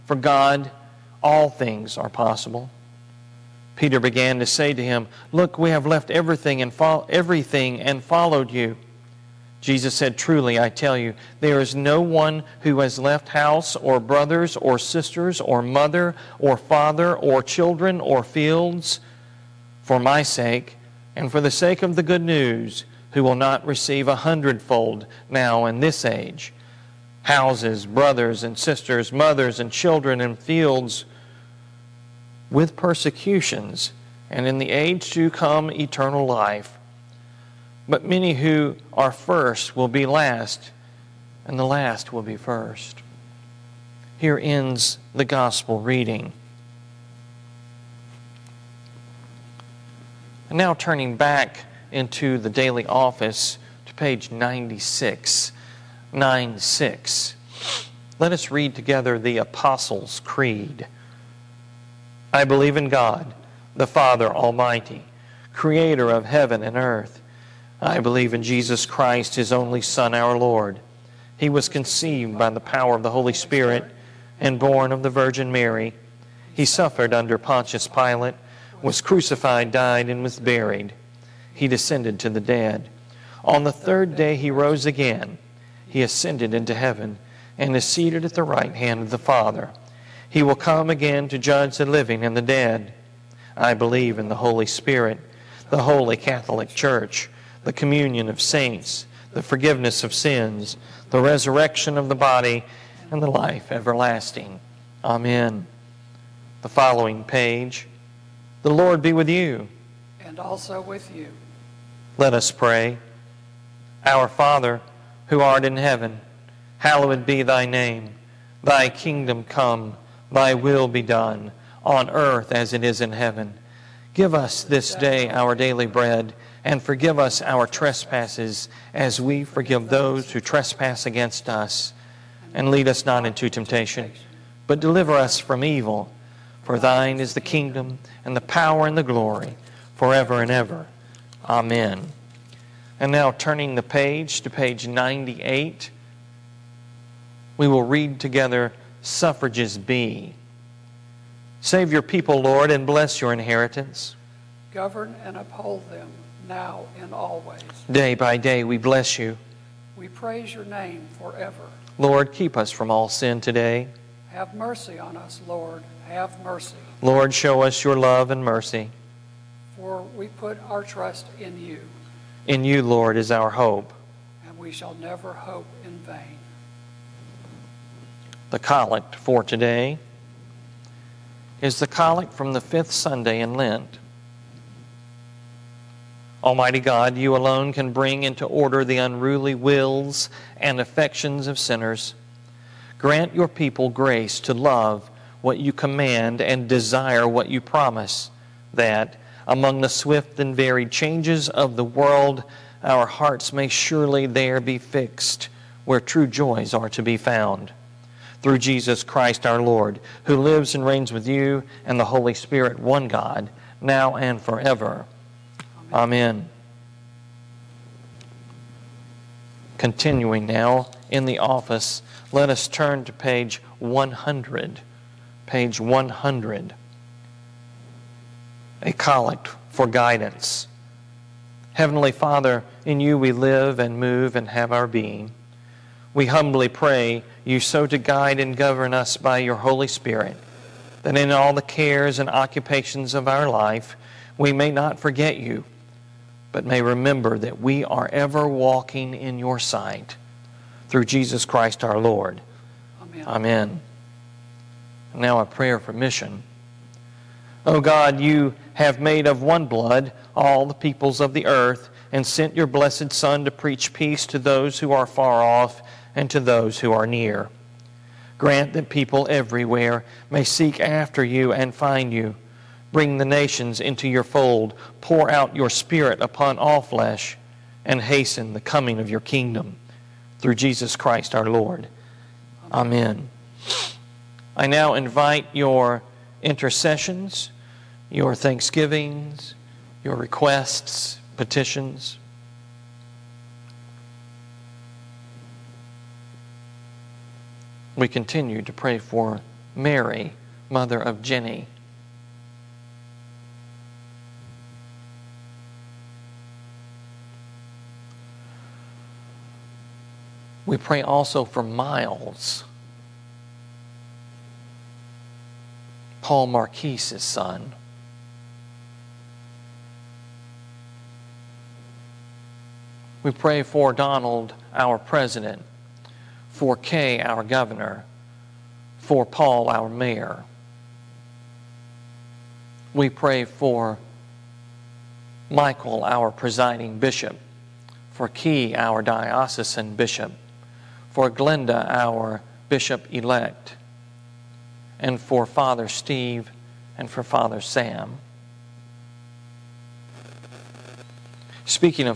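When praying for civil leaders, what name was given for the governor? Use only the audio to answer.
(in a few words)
Kay.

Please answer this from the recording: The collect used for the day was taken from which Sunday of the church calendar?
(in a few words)
Fifth Sunday in Lent.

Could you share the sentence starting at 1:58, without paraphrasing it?
Thy kingdom come, thy will be done, on earth as it is in heaven.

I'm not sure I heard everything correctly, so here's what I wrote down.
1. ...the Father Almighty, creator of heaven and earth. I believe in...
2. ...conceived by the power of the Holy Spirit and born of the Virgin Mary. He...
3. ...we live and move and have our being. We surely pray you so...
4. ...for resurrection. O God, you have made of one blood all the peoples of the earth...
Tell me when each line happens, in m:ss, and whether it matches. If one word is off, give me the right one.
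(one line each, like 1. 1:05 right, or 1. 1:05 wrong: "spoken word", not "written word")
1. 1:03 right
2. 1:11 right
3. 3:53 wrong: "humbly", not "surely"
4. 4:15 wrong: "mission", not "resurrection".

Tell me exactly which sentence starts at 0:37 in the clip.
But many who are first will be last, and the last will be first.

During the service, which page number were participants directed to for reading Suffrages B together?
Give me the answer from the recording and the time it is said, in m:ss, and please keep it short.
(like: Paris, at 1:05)
98, at 2:24.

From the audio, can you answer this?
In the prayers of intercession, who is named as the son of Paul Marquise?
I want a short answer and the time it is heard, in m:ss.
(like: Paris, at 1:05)
Miles, at 5:11.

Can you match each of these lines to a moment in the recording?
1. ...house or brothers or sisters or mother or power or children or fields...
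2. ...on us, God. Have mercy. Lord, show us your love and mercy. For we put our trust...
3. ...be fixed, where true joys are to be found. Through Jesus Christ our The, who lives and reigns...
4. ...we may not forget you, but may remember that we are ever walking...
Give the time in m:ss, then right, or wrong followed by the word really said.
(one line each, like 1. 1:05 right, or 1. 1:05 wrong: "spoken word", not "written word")
1. 0:13 wrong: "father", not "power"
2. 2:44 wrong: "Lord", not "God"
3. 3:24 wrong: "Lord", not "The"
4. 4:04 right.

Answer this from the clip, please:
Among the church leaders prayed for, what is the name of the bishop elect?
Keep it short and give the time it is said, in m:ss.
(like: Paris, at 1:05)
Glenda, at 5:41.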